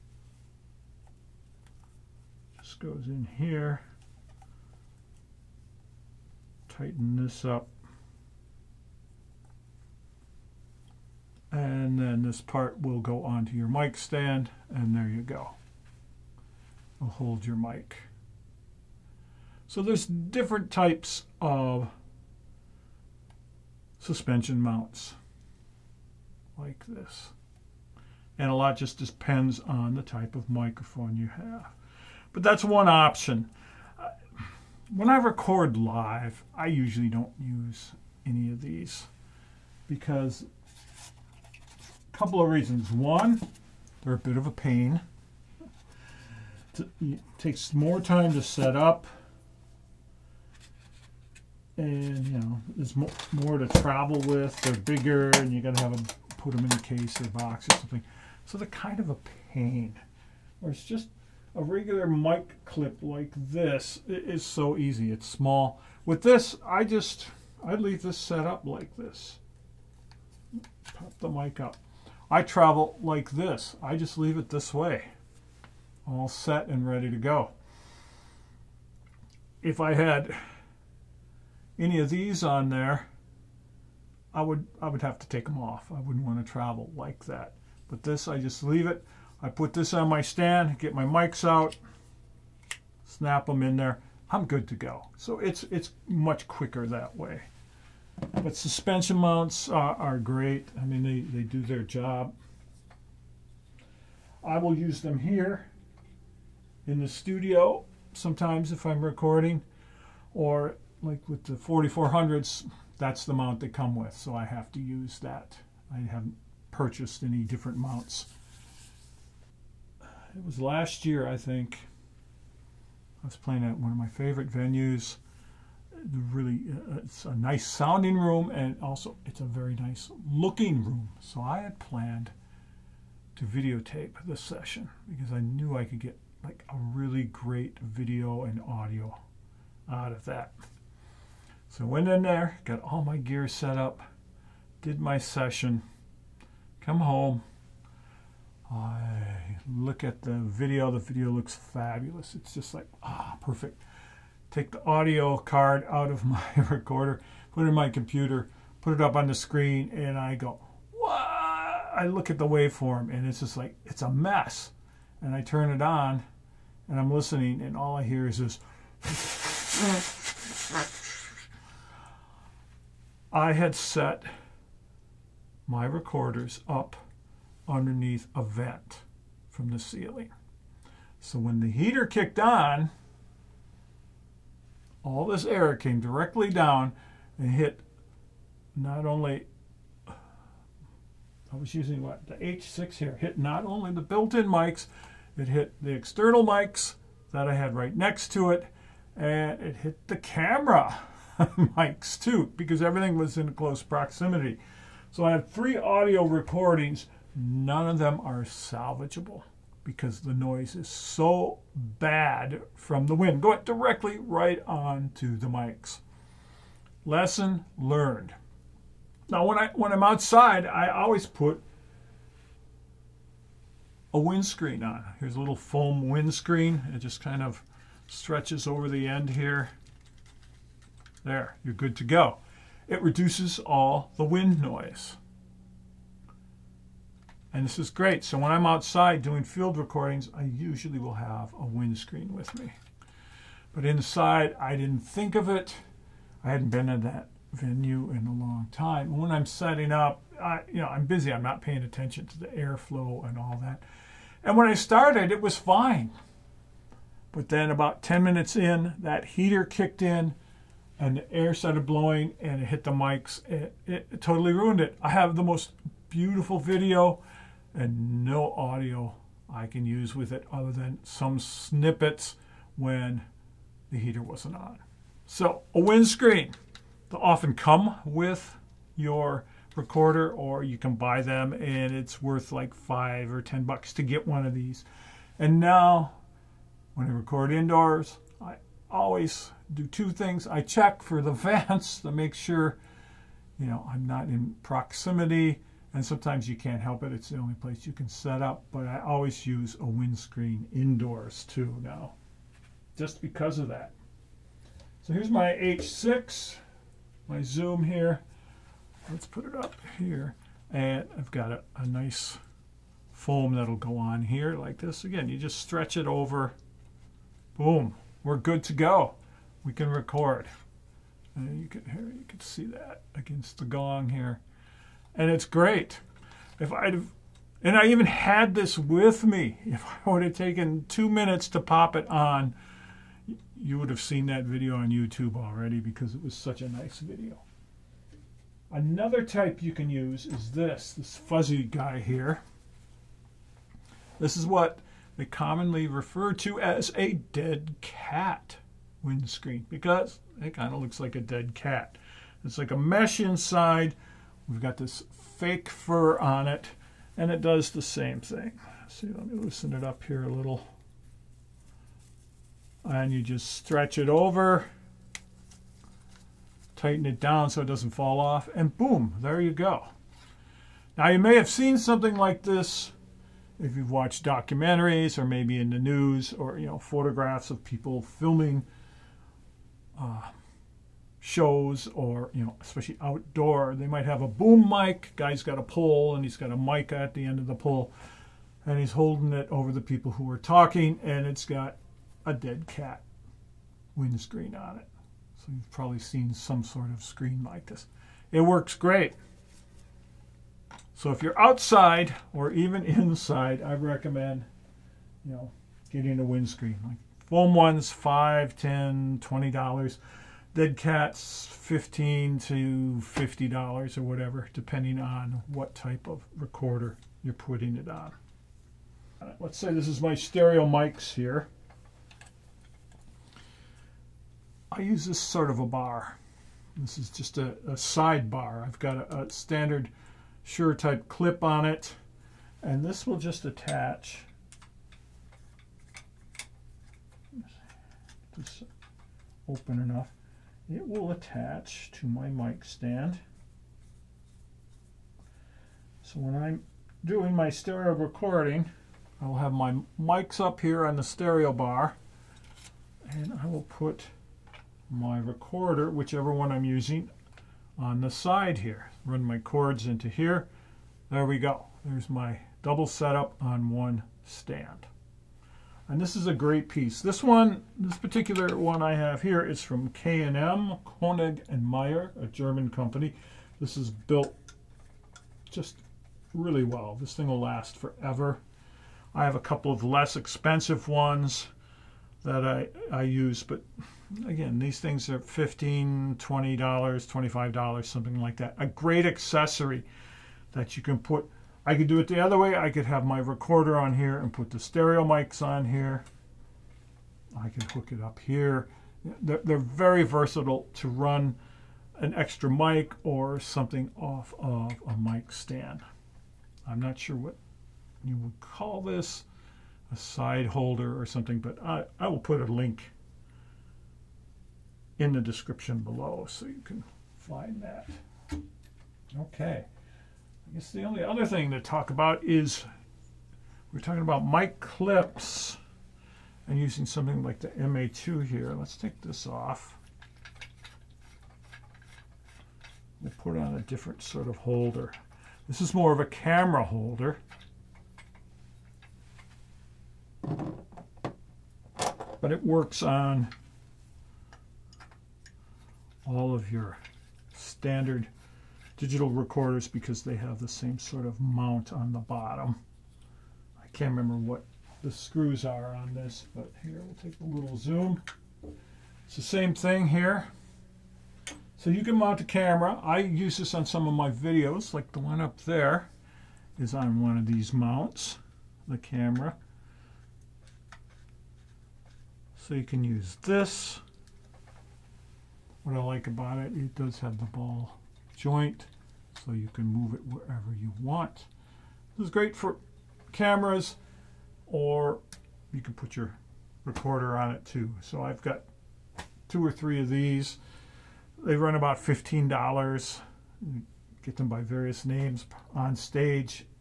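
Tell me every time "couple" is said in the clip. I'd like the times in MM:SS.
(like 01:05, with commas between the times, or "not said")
00:42, 07:59.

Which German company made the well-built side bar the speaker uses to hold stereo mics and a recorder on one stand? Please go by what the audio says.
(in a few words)
Koenig and Meyer.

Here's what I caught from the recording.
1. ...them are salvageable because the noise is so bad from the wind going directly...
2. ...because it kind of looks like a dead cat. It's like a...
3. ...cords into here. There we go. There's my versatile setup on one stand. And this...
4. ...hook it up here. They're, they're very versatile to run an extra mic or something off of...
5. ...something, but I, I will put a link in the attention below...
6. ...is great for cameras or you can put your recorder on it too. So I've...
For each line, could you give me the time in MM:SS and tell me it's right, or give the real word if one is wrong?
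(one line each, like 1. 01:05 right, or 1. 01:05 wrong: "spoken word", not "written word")
1. 03:27 right
2. 05:49 right
3. 07:39 wrong: "double", not "versatile"
4. 08:17 right
5. 08:31 wrong: "description", not "attention"
6. 09:42 right.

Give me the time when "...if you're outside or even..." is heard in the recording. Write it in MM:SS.
06:41.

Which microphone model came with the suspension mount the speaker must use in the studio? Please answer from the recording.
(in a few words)
4400s.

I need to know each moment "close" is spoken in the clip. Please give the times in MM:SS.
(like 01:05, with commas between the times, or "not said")
03:23.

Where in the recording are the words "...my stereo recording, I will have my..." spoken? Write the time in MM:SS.
07:27.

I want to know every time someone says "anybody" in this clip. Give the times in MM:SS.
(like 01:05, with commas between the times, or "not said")
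not said.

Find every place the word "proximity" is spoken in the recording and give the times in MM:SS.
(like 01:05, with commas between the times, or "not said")
03:23, 04:54.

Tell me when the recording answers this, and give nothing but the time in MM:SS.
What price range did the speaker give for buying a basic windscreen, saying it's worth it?
04:42.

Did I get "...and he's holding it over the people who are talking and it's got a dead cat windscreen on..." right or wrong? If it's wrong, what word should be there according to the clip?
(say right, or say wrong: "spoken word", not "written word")
right.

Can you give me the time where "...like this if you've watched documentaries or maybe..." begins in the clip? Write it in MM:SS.
06:12.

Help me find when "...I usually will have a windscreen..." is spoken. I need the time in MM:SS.
04:00.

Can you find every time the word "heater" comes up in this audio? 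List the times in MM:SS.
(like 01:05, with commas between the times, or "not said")
03:01, 04:19, 04:33.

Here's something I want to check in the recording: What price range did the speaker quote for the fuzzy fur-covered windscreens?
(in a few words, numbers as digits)
$15 to $50.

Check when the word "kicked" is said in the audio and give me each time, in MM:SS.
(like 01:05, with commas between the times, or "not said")
03:02, 04:19.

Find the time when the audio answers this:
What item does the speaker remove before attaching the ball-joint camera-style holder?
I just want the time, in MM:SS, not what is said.
08:47.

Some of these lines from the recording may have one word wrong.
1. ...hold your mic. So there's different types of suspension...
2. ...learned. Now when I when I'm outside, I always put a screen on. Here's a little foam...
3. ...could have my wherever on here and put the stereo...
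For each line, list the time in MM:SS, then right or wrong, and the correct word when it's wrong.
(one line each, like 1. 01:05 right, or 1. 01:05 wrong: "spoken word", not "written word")
1. 00:17 right
2. 03:37 wrong: "windscreen", not "screen"
3. 08:12 wrong: "recorder", not "wherever".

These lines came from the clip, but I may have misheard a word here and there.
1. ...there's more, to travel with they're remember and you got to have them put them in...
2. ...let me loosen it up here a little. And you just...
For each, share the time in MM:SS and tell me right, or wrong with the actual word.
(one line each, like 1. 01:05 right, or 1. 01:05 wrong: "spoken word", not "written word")
1. 00:52 wrong: "bigger", not "remember"
2. 05:59 right.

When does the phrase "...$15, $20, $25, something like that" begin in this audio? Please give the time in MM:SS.
08:05.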